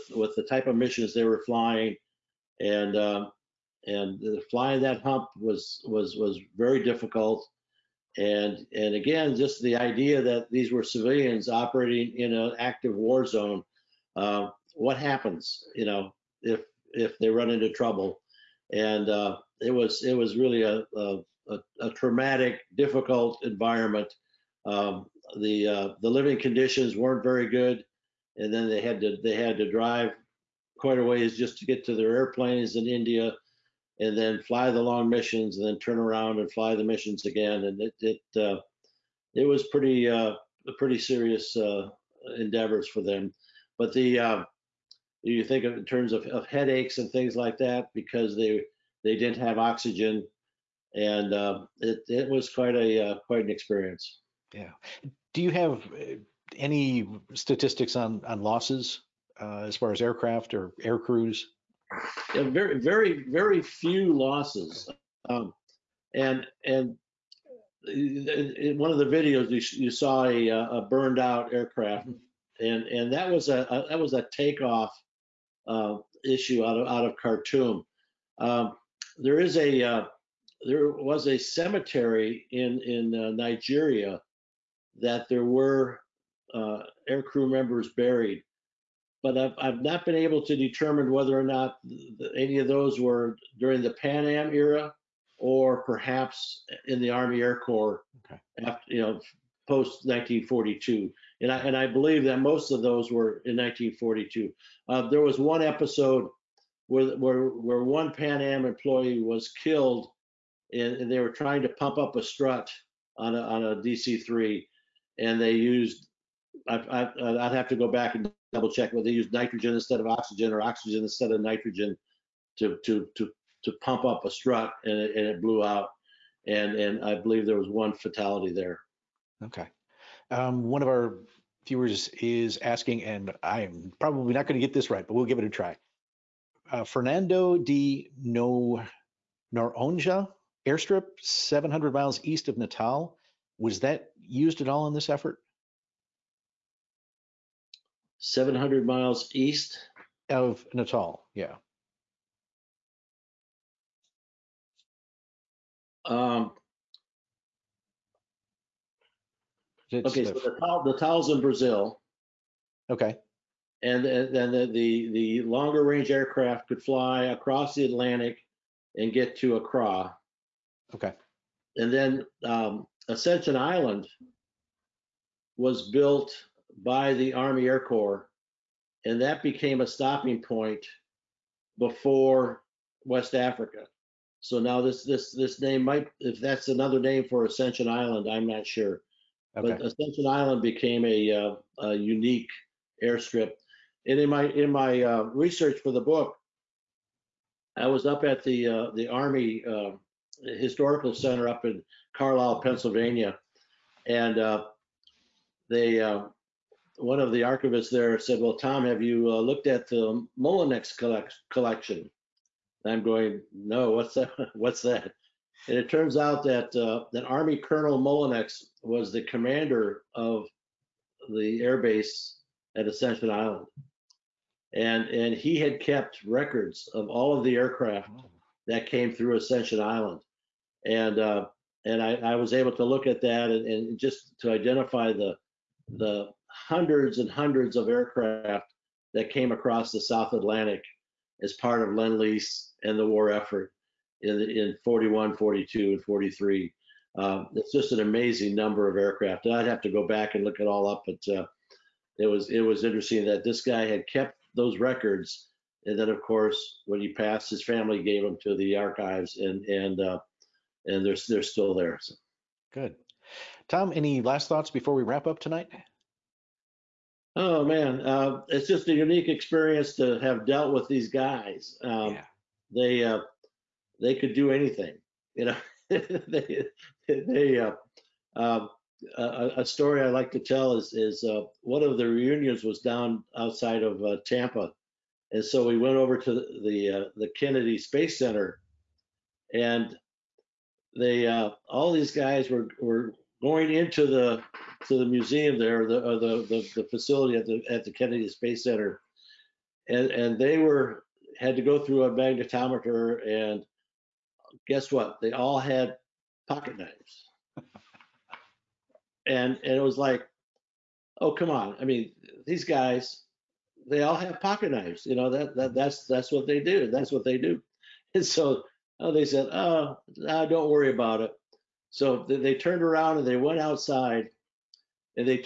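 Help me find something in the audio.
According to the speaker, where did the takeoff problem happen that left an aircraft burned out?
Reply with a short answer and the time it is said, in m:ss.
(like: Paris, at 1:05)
Khartoum, at 1:17.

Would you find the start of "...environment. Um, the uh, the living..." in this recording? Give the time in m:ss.
0:23.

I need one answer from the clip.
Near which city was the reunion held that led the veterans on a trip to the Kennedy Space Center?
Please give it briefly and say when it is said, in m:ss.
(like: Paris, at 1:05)
Tampa, at 4:44.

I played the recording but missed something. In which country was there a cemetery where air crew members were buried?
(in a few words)
Nigeria.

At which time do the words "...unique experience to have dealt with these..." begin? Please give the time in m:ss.
4:28.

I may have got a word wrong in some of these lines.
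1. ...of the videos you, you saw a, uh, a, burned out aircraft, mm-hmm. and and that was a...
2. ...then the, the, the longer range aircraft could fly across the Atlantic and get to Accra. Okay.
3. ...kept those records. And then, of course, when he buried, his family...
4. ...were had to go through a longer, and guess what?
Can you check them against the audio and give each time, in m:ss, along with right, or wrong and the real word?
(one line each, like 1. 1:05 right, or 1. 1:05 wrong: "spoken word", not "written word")
1. 1:08 right
2. 2:44 right
3. 4:14 wrong: "passed", not "buried"
4. 5:00 wrong: "magnetometer", not "longer".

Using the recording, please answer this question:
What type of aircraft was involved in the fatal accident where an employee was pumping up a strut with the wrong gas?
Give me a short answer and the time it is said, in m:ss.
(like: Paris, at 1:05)
DC-3, at 1:53.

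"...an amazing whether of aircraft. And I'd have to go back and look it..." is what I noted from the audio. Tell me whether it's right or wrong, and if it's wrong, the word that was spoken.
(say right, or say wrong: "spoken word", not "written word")
wrong: "number", not "whether".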